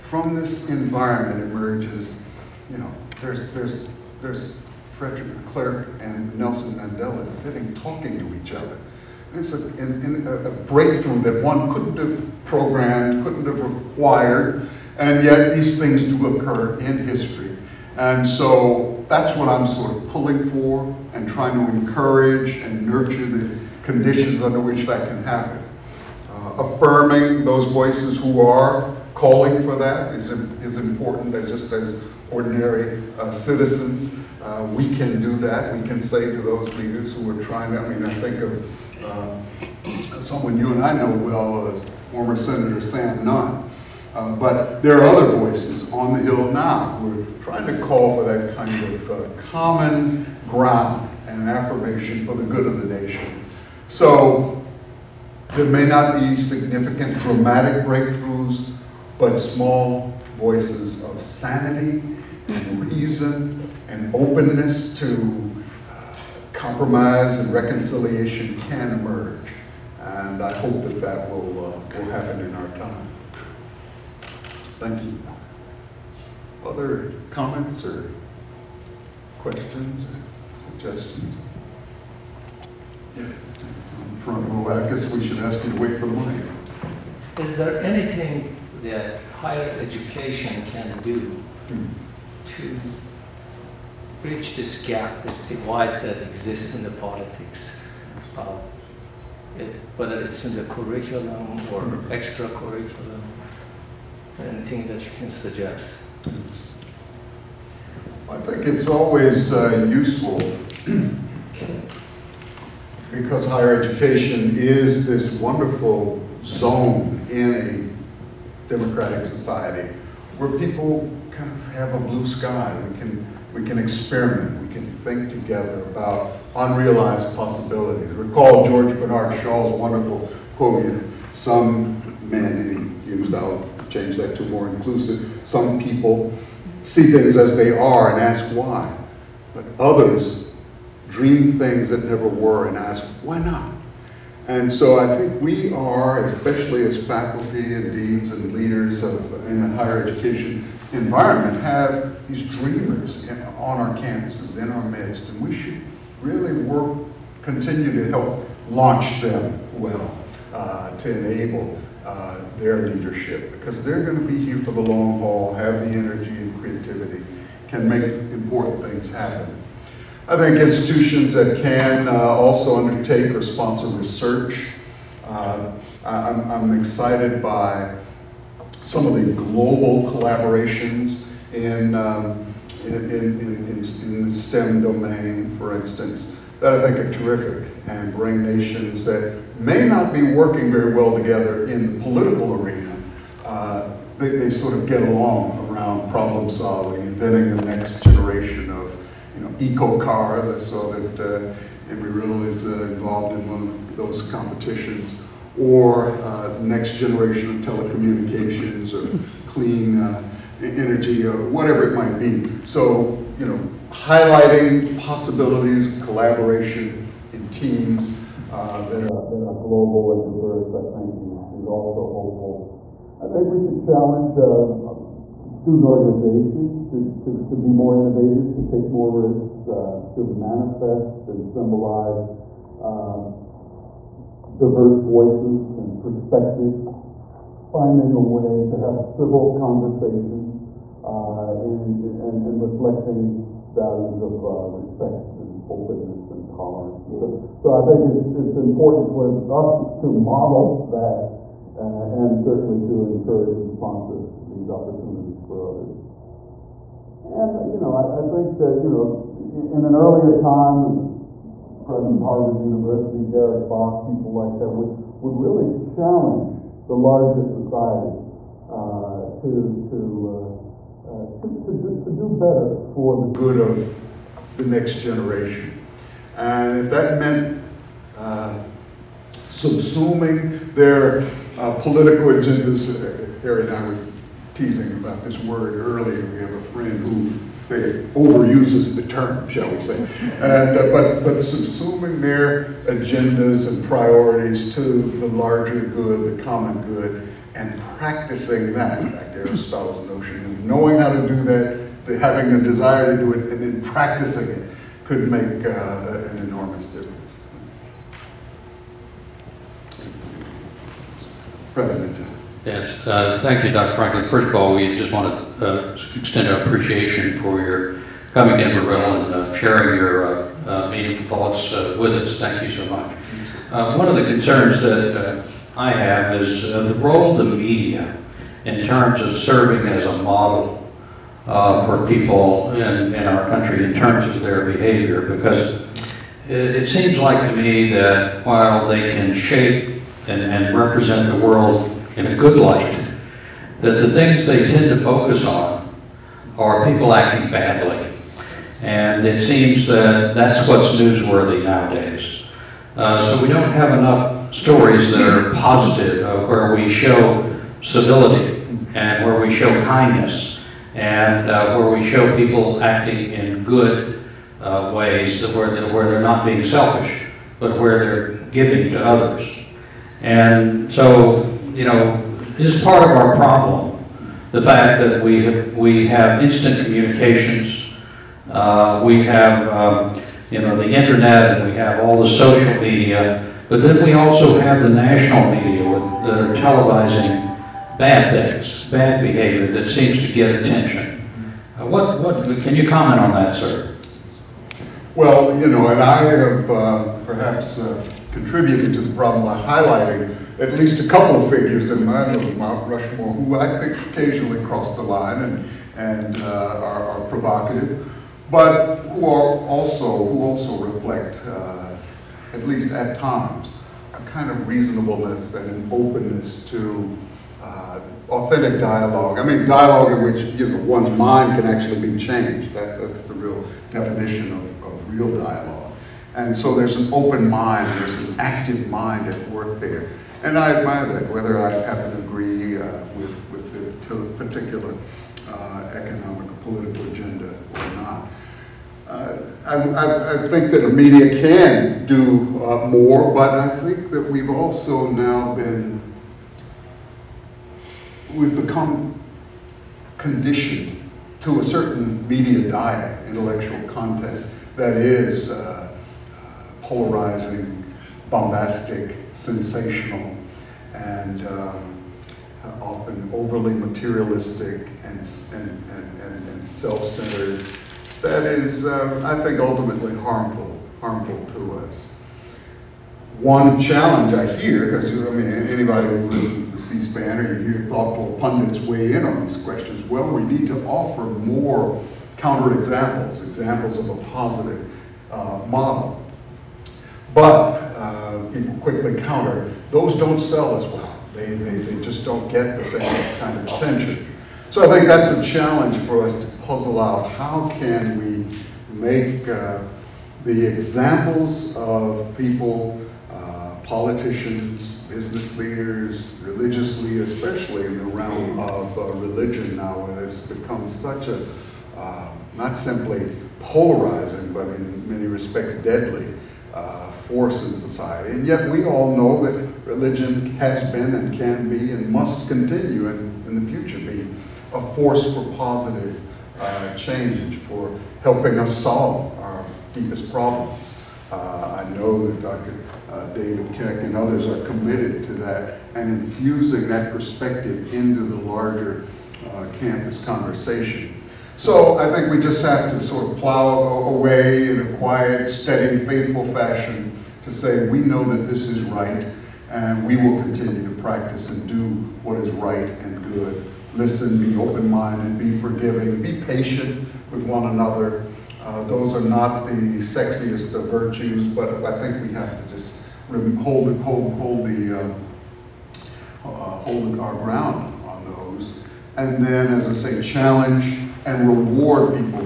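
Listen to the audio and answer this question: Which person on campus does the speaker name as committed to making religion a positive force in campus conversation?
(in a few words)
David Keck.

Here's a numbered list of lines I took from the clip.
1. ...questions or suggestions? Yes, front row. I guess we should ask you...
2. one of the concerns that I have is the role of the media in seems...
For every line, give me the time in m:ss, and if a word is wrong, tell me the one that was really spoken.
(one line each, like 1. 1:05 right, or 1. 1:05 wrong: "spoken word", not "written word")
1. 1:19 right
2. 5:23 wrong: "terms", not "seems".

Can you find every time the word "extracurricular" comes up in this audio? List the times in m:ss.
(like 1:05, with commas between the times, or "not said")
1:42.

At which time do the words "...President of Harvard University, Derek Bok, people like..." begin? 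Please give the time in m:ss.
4:21.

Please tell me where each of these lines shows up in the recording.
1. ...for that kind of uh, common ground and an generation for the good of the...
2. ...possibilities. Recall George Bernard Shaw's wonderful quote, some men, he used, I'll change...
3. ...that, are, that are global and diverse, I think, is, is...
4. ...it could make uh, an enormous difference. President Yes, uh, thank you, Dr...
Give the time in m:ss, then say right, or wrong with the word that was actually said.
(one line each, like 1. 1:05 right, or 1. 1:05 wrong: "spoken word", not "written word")
1. 0:48 wrong: "affirmation", not "generation"
2. 2:07 right
3. 3:38 right
4. 5:04 right.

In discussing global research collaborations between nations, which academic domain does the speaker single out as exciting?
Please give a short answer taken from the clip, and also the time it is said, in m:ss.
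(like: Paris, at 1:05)
STEM, at 3:04.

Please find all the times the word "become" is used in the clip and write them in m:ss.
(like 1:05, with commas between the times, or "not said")
7:28, 8:30.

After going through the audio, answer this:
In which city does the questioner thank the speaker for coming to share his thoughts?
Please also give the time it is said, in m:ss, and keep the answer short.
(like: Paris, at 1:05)
Amarillo, at 5:18.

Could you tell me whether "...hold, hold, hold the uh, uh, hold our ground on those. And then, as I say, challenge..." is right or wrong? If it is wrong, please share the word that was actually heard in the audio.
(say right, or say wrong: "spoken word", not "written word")
right.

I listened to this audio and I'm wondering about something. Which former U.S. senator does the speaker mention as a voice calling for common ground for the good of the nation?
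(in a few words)
Sam Nunn.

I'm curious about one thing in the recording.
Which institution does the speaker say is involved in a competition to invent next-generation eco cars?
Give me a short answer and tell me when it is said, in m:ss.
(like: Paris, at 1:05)
Embry-Riddle, at 3:21.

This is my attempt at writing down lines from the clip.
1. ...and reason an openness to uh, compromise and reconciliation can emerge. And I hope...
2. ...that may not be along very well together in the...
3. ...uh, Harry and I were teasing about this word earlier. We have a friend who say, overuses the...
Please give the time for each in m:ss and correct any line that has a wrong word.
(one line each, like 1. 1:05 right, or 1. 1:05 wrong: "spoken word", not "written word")
1. 1:02 right
2. 3:09 wrong: "working", not "along"
3. 4:43 right.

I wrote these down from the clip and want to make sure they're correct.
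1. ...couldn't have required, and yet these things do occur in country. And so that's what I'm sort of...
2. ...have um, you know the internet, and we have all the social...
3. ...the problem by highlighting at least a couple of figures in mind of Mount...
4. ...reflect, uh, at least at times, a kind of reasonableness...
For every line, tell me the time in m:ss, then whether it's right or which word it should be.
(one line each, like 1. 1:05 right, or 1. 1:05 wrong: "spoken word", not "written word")
1. 0:13 wrong: "history", not "country"
2. 6:19 right
3. 6:38 right
4. 6:50 right.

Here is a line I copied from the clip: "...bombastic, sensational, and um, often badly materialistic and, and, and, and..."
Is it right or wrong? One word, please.
wrong.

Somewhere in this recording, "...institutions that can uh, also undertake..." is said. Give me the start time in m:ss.
2:50.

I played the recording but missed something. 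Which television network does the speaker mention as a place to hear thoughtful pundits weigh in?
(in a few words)
C-SPAN.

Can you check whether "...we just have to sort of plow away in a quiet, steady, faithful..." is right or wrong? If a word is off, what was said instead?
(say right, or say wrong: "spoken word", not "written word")
right.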